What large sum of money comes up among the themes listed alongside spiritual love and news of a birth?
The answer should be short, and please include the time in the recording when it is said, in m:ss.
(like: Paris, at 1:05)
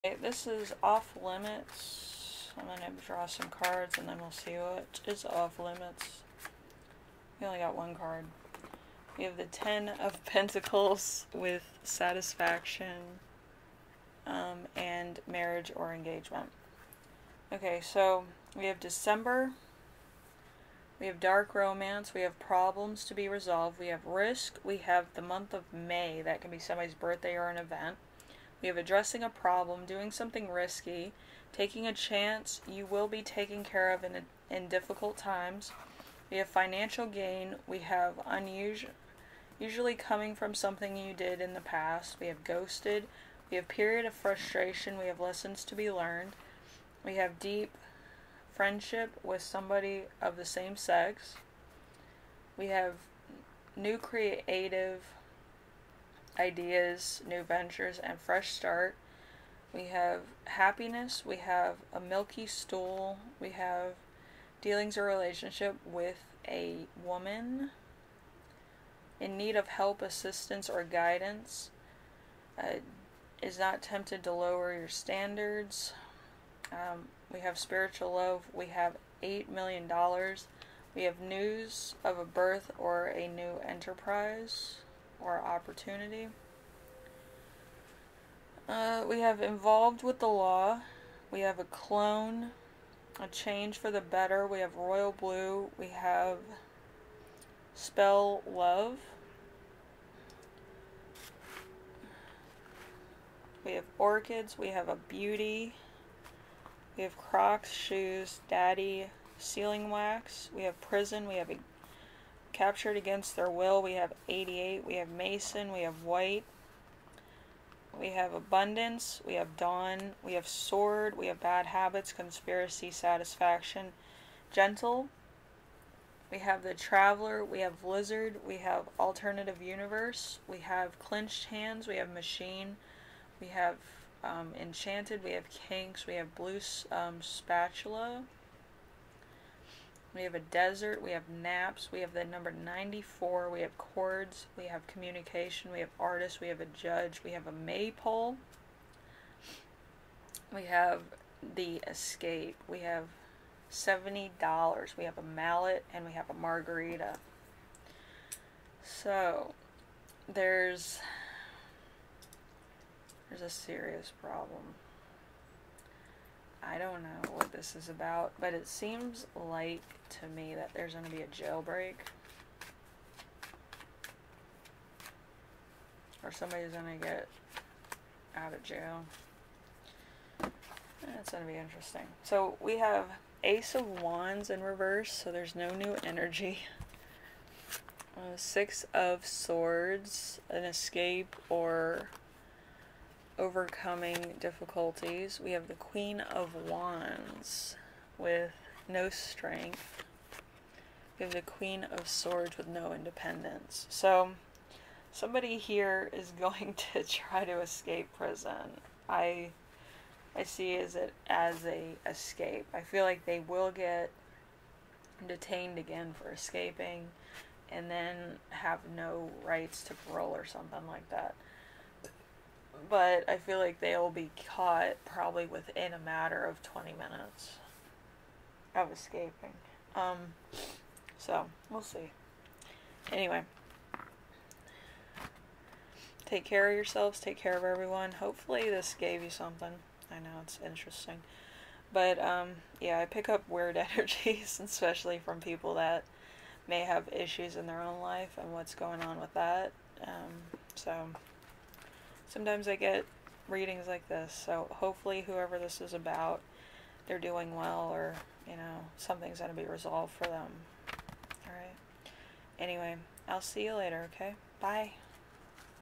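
$8 million, at 1:19.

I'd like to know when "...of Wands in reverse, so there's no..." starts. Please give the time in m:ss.
3:03.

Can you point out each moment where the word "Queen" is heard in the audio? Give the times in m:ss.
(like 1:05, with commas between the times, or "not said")
3:15, 3:21.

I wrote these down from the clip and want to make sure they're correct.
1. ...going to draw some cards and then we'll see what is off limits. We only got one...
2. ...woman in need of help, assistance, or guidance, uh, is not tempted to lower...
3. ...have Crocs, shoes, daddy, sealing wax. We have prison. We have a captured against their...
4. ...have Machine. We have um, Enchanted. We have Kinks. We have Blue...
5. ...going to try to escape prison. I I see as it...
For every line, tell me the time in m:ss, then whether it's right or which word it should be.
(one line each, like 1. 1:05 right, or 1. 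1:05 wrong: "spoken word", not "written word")
1. 0:02 right
2. 1:07 right
3. 1:47 right
4. 2:11 right
5. 3:26 right.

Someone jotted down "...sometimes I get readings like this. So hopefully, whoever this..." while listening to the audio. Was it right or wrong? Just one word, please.
right.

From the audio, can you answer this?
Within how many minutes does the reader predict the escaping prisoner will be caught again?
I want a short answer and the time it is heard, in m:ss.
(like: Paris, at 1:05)
20, at 3:46.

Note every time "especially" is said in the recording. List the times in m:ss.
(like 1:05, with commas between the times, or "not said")
4:04.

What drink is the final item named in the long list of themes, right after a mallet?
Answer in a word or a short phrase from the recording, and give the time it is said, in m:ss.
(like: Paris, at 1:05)
margarita, at 2:36.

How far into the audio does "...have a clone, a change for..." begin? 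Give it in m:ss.
1:31.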